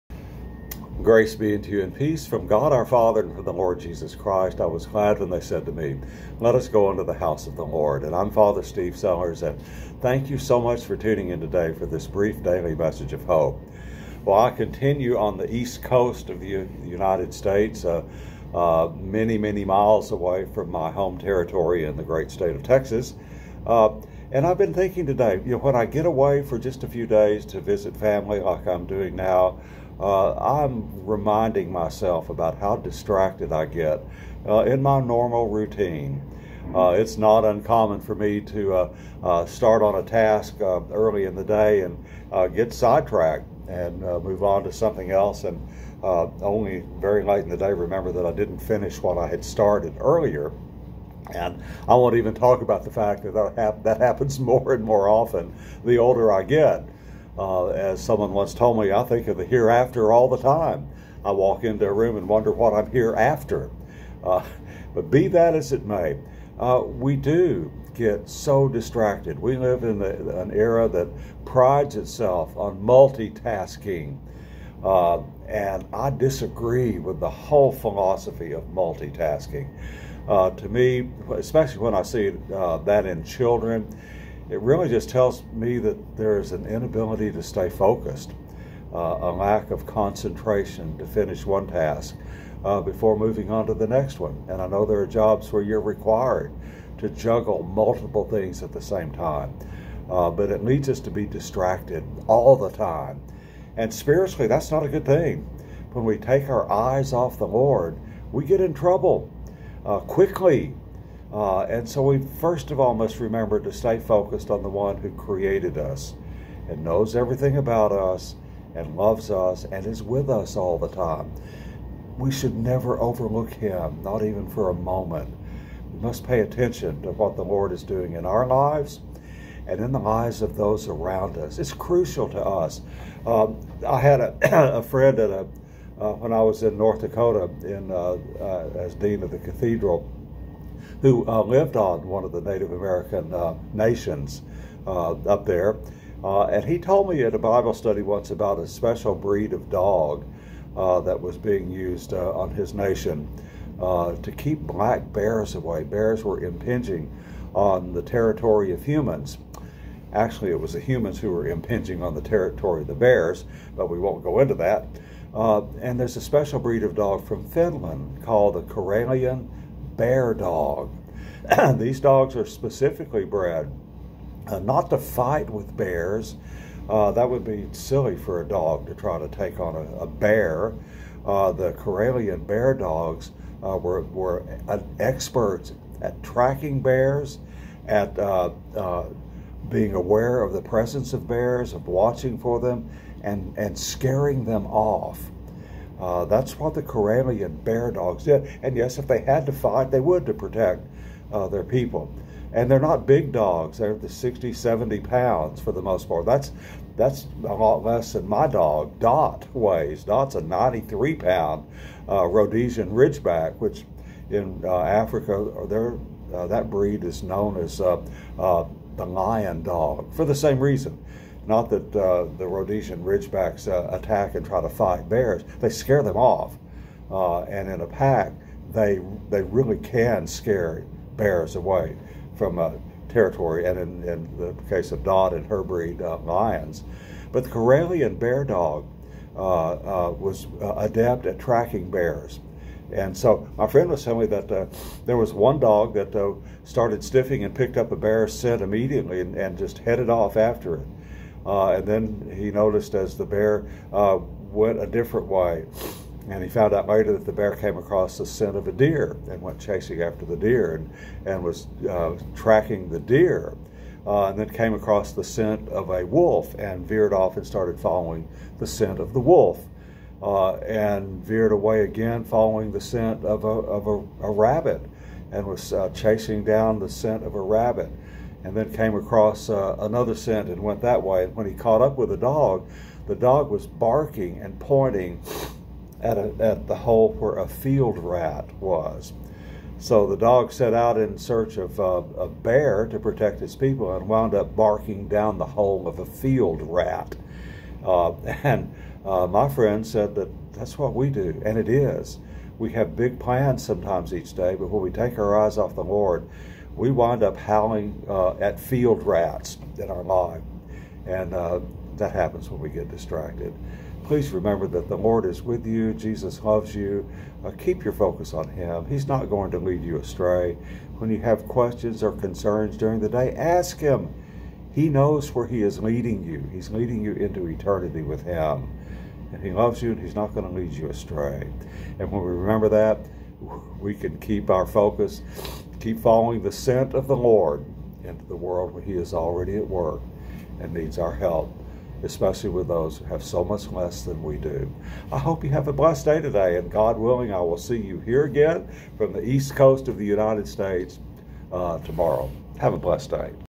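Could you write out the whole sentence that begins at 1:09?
We live in an era that prides itself on multitasking.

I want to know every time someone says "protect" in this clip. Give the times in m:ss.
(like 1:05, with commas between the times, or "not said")
3:20, 4:52.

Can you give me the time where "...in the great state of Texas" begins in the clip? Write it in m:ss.
0:21.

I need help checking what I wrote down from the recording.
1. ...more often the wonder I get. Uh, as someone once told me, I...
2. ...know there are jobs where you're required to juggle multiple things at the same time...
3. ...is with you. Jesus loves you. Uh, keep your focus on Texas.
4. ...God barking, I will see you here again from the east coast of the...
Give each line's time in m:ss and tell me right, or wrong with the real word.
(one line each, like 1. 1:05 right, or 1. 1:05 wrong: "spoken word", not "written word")
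1. 0:54 wrong: "older", not "wonder"
2. 1:34 right
3. 5:15 wrong: "Him", not "Texas"
4. 5:46 wrong: "willing", not "barking".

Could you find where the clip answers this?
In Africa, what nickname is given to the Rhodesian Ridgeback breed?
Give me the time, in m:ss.
3:38.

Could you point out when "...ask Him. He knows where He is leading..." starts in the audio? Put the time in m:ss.
5:23.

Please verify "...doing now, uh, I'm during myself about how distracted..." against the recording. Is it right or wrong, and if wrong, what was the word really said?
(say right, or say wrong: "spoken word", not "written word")
wrong: "reminding", not "during".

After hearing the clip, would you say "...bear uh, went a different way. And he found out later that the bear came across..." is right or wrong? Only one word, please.
right.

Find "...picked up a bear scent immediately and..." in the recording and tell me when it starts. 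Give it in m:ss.
4:07.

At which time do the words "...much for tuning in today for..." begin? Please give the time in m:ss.
0:10.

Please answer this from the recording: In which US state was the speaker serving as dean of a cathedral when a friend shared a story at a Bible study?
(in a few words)
North Dakota.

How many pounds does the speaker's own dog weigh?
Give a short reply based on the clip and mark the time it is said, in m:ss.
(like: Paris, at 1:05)
93, at 3:30.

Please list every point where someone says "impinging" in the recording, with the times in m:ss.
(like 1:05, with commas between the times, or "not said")
2:36, 2:41.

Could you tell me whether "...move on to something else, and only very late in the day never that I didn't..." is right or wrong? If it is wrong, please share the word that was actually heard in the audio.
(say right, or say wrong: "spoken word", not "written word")
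wrong: "remember", not "never".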